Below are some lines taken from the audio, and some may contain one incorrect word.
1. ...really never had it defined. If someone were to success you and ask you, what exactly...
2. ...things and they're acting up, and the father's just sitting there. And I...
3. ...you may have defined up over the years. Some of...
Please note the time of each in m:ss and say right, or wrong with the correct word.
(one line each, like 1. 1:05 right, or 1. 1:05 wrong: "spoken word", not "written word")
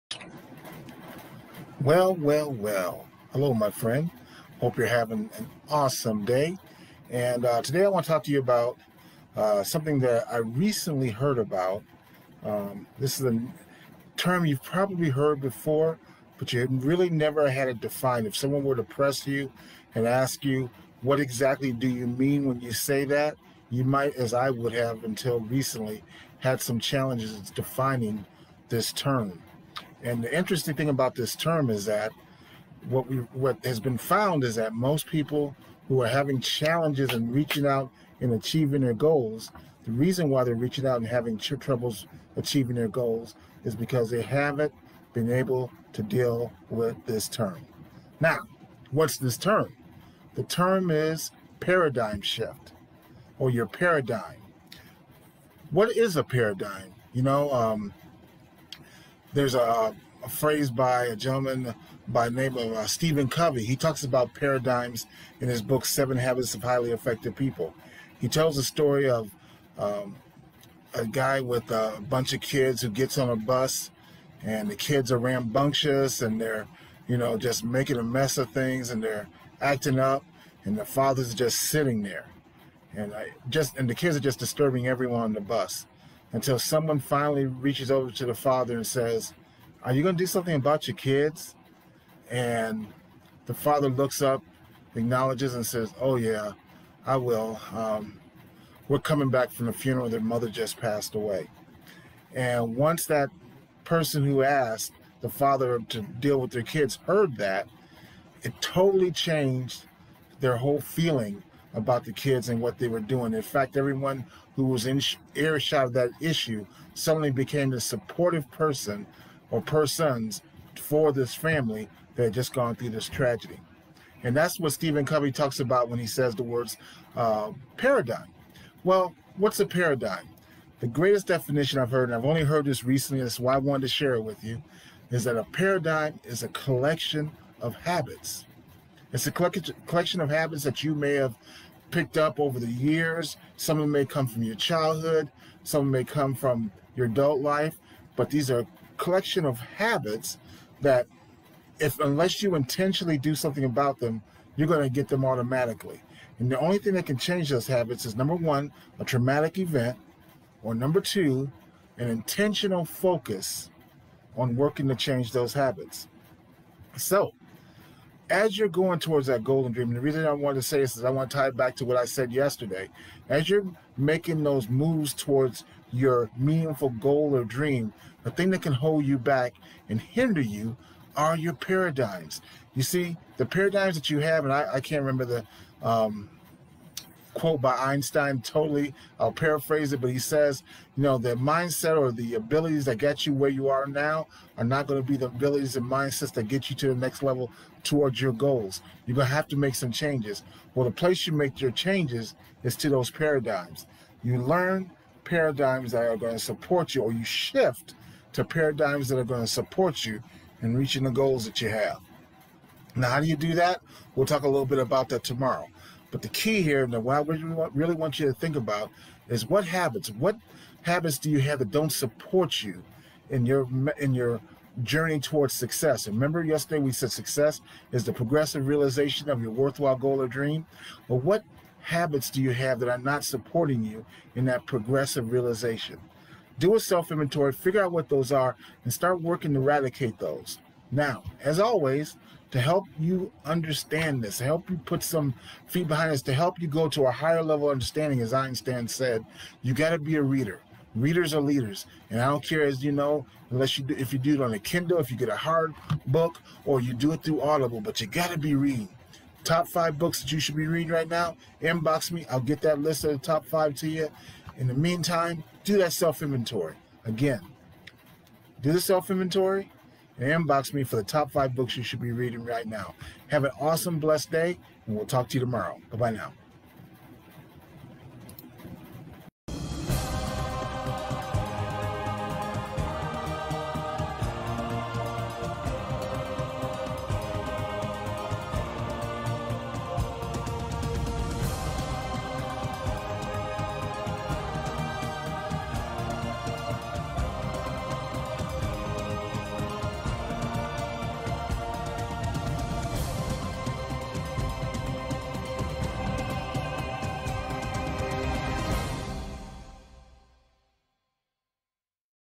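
1. 0:16 wrong: "press", not "success"
2. 1:18 right
3. 2:20 wrong: "picked", not "defined".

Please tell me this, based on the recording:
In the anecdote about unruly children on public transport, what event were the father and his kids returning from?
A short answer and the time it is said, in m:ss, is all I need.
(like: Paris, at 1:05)
the funeral, at 1:39.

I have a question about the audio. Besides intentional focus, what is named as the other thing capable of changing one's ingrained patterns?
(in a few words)
a traumatic event.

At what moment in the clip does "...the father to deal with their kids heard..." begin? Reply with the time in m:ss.
1:45.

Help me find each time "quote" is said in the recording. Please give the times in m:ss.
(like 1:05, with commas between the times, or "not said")
3:07.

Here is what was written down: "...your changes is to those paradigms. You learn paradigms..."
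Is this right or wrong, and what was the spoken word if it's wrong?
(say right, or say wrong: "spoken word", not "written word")
right.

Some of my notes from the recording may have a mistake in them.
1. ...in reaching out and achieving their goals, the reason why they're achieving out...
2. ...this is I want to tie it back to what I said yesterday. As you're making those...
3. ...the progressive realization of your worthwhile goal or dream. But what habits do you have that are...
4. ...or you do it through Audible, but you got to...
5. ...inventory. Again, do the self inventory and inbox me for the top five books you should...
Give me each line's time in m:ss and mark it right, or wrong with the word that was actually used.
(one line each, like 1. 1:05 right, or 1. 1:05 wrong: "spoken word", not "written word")
1. 0:37 wrong: "reaching", not "achieving"
2. 2:50 right
3. 3:48 right
4. 4:16 right
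5. 4:26 right.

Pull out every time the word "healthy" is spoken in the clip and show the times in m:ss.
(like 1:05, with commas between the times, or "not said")
not said.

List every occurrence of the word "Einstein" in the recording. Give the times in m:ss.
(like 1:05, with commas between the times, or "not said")
3:07, 4:08.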